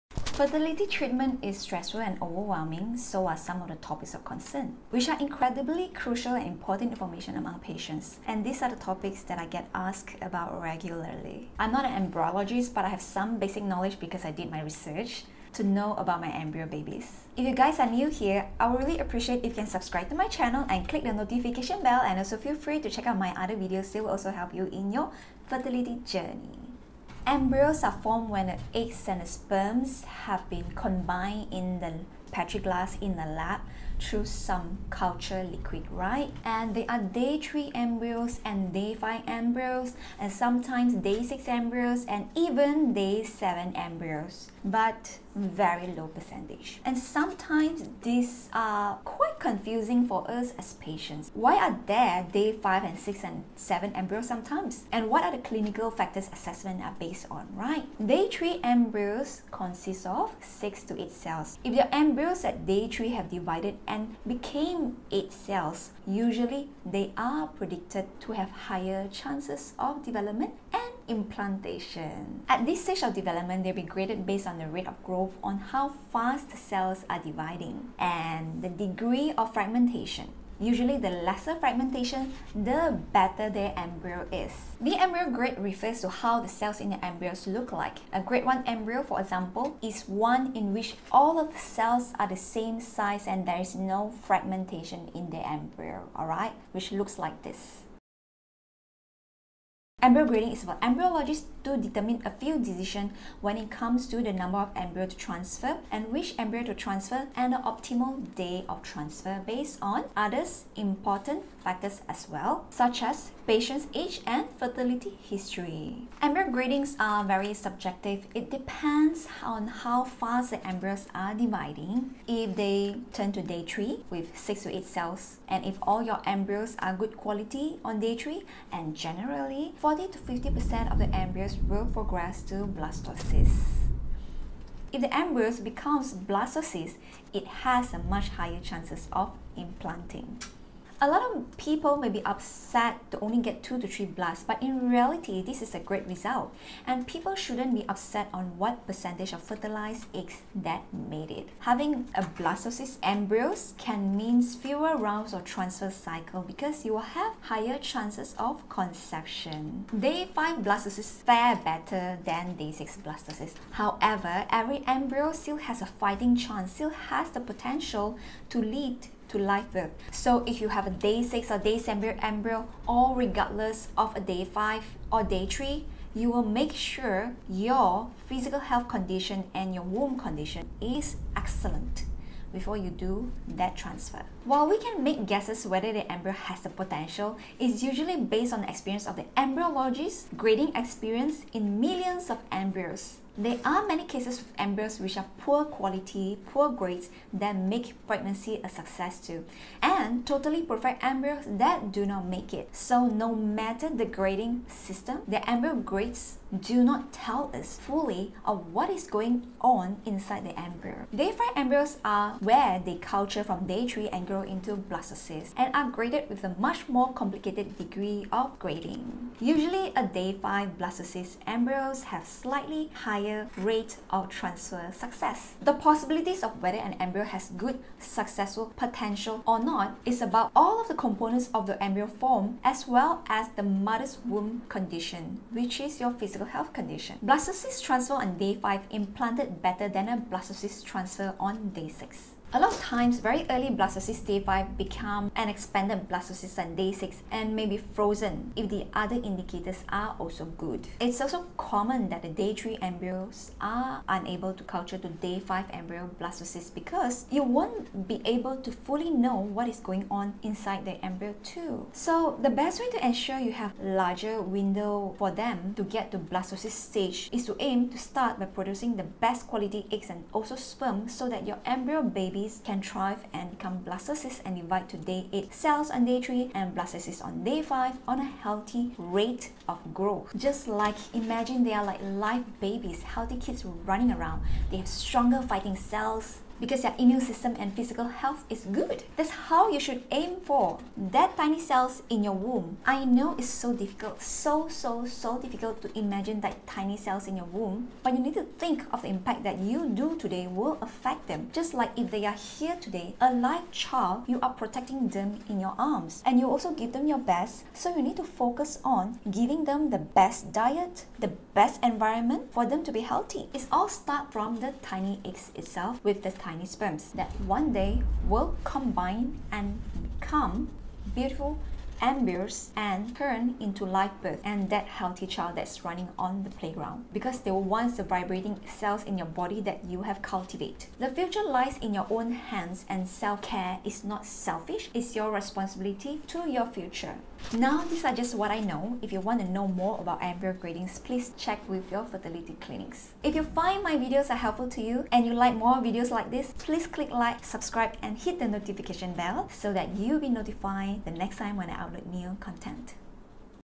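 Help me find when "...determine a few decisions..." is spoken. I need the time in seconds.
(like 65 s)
101 s.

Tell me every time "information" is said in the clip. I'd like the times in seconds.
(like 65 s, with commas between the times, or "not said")
6 s.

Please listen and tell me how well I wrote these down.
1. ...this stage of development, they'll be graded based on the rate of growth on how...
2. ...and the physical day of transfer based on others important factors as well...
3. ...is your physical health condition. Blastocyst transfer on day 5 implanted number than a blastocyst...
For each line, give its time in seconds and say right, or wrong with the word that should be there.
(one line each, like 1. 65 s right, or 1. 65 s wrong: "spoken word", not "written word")
1. 72 s right
2. 107 s wrong: "optimal", not "physical"
3. 235 s wrong: "better", not "number".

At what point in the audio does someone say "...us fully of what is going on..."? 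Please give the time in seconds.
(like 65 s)
207 s.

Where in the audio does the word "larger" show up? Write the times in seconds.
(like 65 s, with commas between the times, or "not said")
263 s.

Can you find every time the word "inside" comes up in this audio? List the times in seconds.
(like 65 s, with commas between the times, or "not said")
210 s, 260 s.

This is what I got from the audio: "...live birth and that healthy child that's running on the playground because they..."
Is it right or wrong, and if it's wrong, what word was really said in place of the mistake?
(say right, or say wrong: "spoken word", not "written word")
right.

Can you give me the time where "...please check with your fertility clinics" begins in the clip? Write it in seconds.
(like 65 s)
341 s.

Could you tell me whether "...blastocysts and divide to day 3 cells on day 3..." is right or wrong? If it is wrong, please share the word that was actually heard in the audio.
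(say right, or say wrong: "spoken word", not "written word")
wrong: "8", not "3".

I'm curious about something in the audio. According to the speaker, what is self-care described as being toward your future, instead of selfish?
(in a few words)
your responsibility.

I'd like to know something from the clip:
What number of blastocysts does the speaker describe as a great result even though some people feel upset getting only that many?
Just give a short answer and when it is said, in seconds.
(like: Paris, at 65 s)
2 to 3, at 143 s.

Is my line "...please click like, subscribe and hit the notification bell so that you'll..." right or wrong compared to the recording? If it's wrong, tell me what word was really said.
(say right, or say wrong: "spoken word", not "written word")
right.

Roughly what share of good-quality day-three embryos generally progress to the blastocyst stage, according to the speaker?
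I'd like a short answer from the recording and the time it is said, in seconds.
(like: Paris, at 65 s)
40 to 50%, at 129 s.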